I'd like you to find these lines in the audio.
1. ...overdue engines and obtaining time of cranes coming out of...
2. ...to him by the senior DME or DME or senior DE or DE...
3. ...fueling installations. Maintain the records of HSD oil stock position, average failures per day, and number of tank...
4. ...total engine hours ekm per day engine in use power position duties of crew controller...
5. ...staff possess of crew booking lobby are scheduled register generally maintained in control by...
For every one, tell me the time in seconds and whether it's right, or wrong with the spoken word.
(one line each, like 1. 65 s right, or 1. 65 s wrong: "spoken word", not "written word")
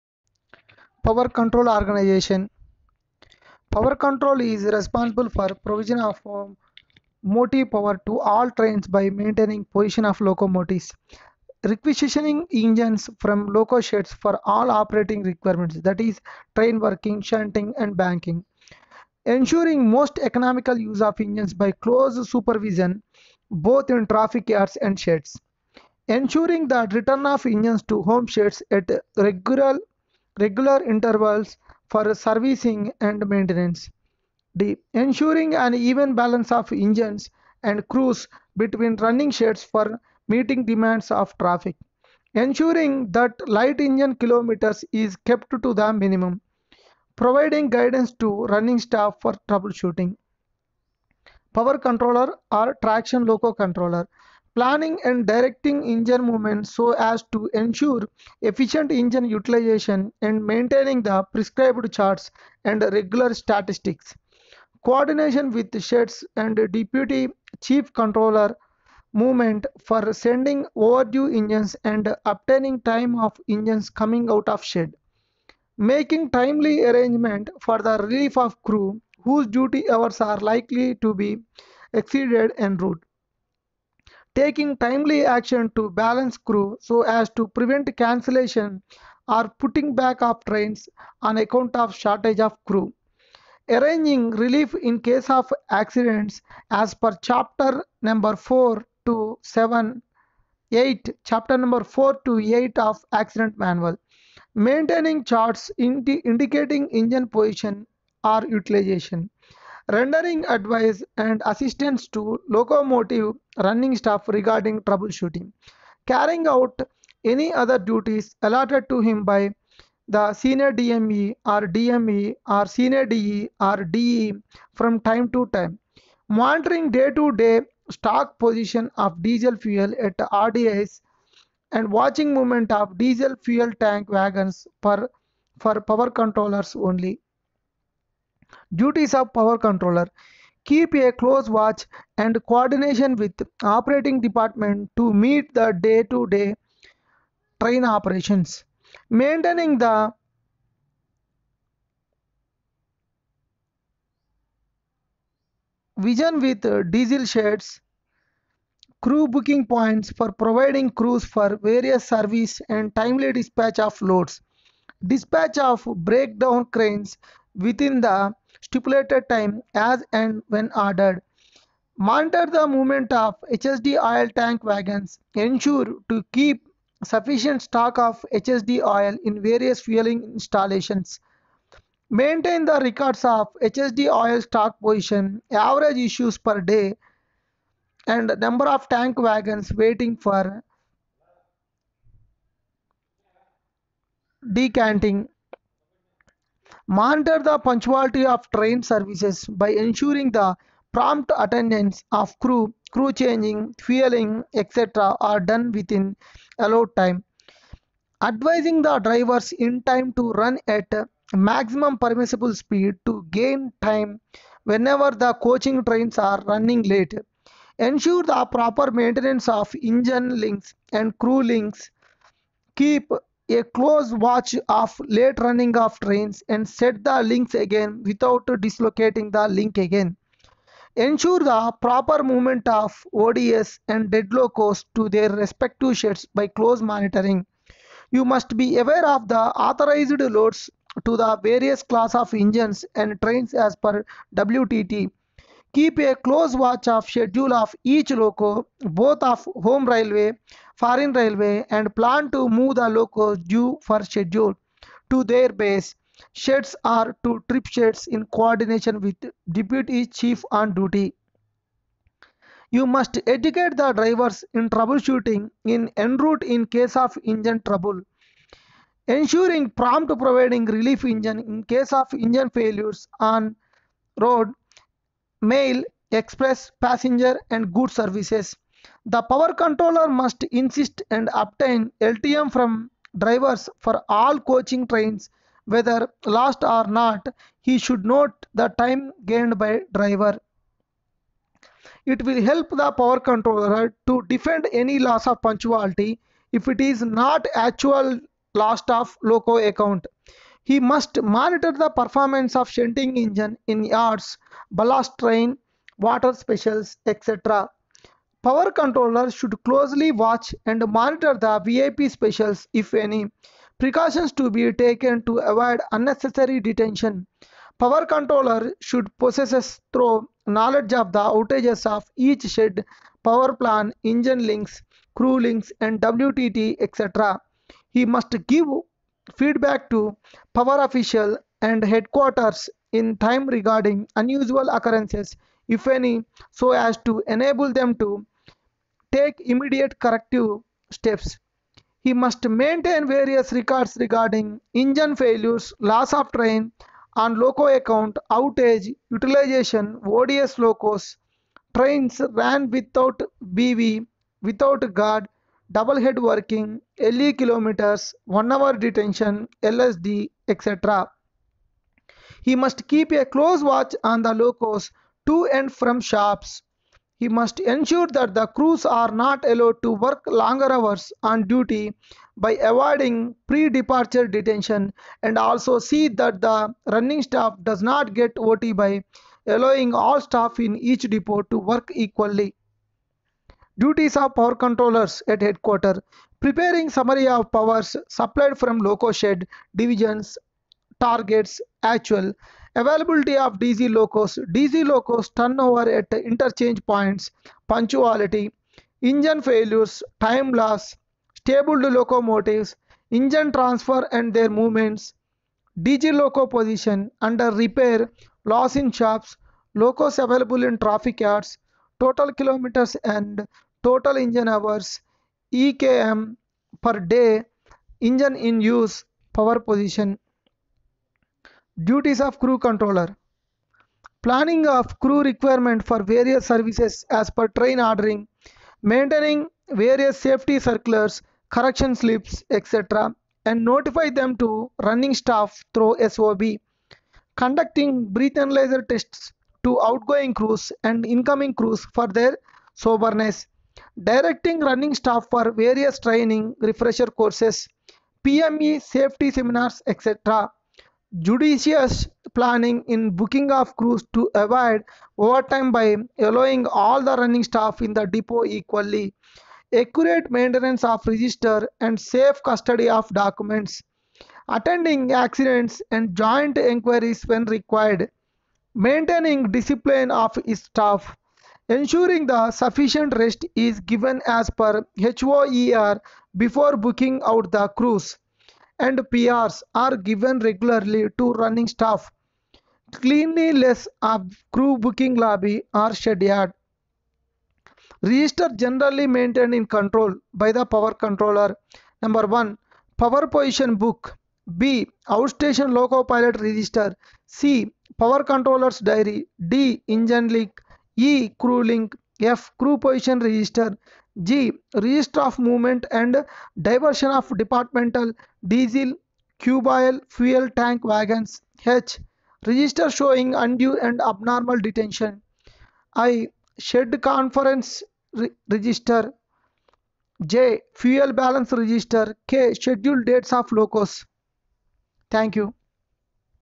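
1. 70 s wrong: "engines", not "cranes"
2. 118 s right
3. 179 s wrong: "issues", not "failures"
4. 413 s right
5. 481 s wrong: "cleanliness", not "possess".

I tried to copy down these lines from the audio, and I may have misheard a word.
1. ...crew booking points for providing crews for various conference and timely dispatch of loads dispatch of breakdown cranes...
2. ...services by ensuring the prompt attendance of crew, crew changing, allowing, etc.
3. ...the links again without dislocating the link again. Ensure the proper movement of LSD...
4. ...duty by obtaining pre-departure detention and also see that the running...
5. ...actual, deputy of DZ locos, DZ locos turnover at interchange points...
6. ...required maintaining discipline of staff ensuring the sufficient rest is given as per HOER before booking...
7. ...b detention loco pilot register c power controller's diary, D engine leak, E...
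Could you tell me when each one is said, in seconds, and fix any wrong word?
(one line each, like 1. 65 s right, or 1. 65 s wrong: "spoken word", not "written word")
1. 159 s wrong: "service", not "conference"
2. 198 s wrong: "fueling", not "allowing"
3. 227 s wrong: "ODS", not "LSD"
4. 371 s wrong: "avoiding", not "obtaining"
5. 391 s wrong: "availability", not "deputy"
6. 467 s right
7. 494 s wrong: "outstation", not "detention".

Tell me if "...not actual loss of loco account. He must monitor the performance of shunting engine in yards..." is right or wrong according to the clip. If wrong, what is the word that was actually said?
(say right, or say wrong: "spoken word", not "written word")
right.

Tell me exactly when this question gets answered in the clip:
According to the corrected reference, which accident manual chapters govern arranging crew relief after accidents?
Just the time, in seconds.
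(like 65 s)
101 s.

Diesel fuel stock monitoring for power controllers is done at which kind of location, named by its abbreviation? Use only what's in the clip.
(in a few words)
RDS.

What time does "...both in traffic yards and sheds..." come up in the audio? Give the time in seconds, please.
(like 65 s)
23 s.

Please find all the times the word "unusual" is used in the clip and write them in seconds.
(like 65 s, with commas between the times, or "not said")
334 s.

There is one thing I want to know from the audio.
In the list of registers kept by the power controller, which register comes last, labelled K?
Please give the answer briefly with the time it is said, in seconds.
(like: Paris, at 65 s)
Scheduled dates of locos, at 522 s.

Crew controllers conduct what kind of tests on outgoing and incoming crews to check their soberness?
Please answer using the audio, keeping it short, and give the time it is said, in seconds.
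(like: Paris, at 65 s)
Analyzer tests, at 438 s.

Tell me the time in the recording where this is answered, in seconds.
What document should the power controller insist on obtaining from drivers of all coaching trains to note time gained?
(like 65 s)
282 s.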